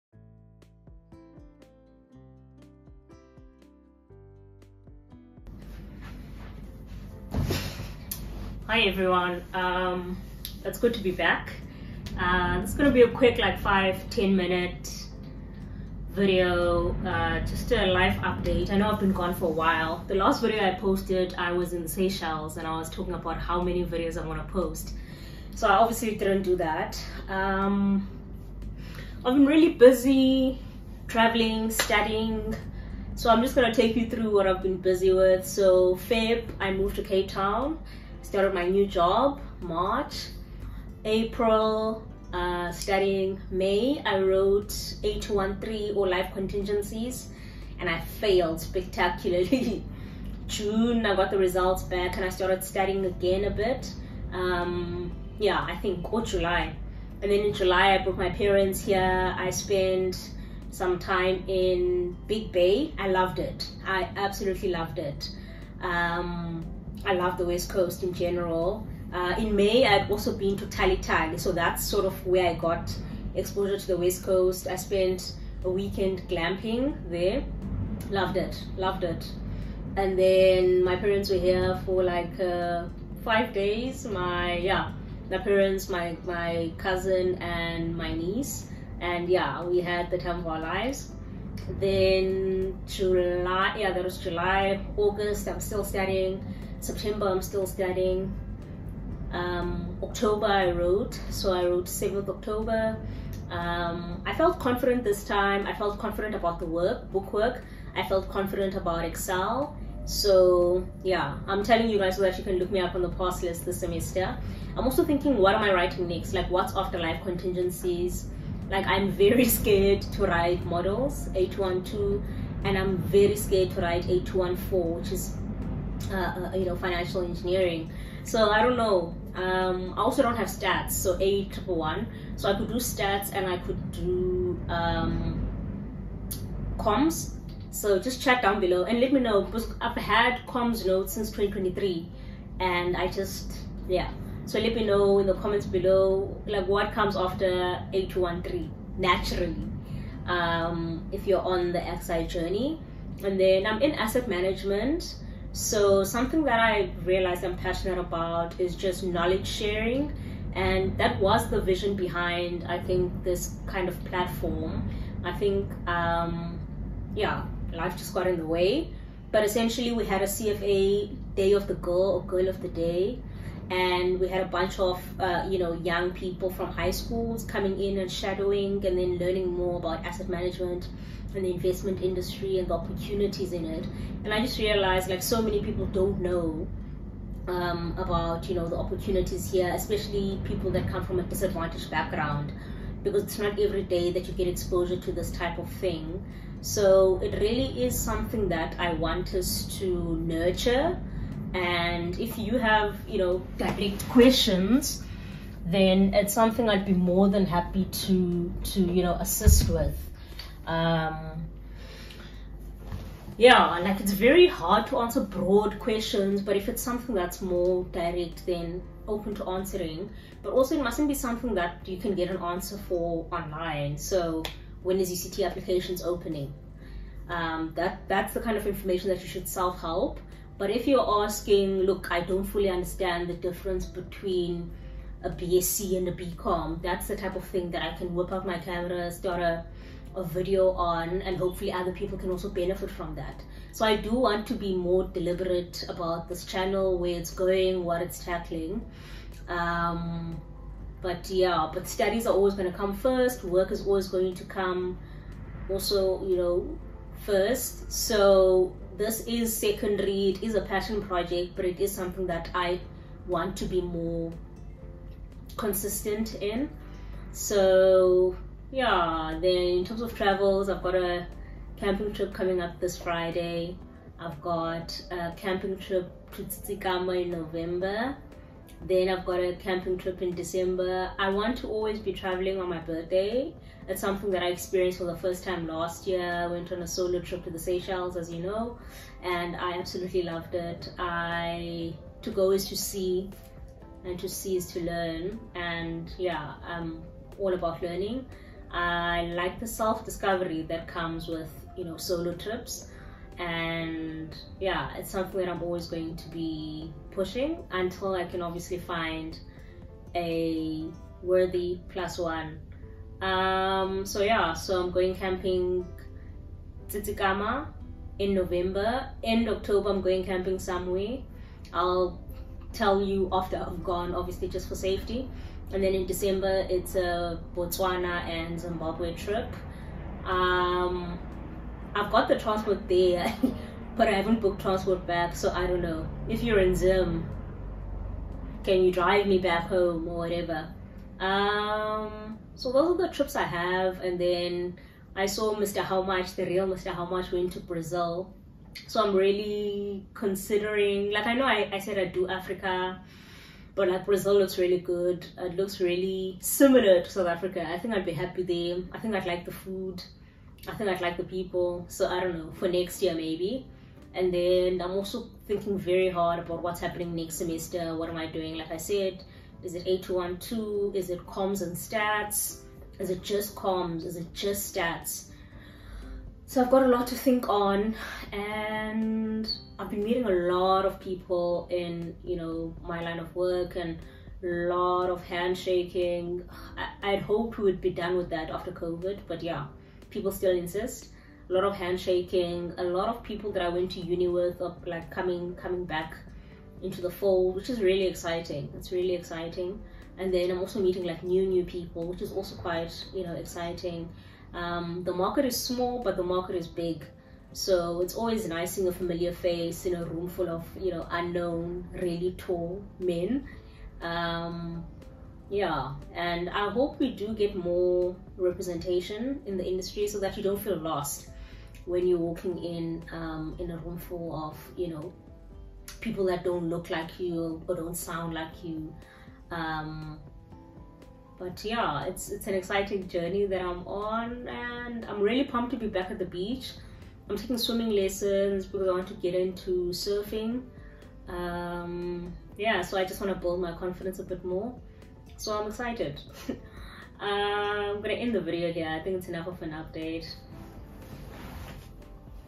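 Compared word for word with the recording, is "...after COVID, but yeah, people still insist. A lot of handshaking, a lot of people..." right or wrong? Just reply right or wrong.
right.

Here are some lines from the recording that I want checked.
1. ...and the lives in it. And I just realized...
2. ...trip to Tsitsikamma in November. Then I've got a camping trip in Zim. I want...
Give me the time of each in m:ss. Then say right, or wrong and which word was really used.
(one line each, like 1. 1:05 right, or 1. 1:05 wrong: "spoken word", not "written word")
1. 3:02 wrong: "opportunities", not "lives"
2. 4:35 wrong: "December", not "Zim".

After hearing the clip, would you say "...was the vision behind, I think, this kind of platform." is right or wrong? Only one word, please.
right.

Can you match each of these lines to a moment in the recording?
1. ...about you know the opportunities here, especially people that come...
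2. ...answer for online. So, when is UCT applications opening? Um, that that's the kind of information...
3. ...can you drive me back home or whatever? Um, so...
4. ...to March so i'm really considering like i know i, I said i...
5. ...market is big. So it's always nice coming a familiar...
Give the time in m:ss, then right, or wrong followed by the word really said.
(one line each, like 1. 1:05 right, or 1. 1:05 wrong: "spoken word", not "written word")
1. 3:07 right
2. 3:42 right
3. 5:38 right
4. 5:47 wrong: "Brazil", not "March"
5. 6:46 wrong: "seeing", not "coming".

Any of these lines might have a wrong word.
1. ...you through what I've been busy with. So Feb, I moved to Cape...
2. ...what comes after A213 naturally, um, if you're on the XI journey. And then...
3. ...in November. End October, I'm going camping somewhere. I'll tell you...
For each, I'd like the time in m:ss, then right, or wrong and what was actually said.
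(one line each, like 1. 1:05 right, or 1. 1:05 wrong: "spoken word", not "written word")
1. 0:33 right
2. 2:26 right
3. 5:18 right.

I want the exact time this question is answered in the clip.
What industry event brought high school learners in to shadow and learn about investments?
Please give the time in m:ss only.
2:50.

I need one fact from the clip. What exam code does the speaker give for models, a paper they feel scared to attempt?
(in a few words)
812.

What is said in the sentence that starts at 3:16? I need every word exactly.
So it really is something that I want us to nurture.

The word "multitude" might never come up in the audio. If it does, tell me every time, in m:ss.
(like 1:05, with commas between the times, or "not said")
not said.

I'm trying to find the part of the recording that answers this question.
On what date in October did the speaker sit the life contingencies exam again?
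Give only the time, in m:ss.
1:41.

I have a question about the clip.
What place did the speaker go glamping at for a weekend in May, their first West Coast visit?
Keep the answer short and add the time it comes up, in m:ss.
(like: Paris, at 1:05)
Tali, at 1:10.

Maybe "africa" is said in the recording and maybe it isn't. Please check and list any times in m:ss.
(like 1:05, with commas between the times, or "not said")
5:52, 5:57.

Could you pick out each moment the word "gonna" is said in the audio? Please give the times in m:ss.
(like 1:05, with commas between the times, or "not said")
0:33, 7:28.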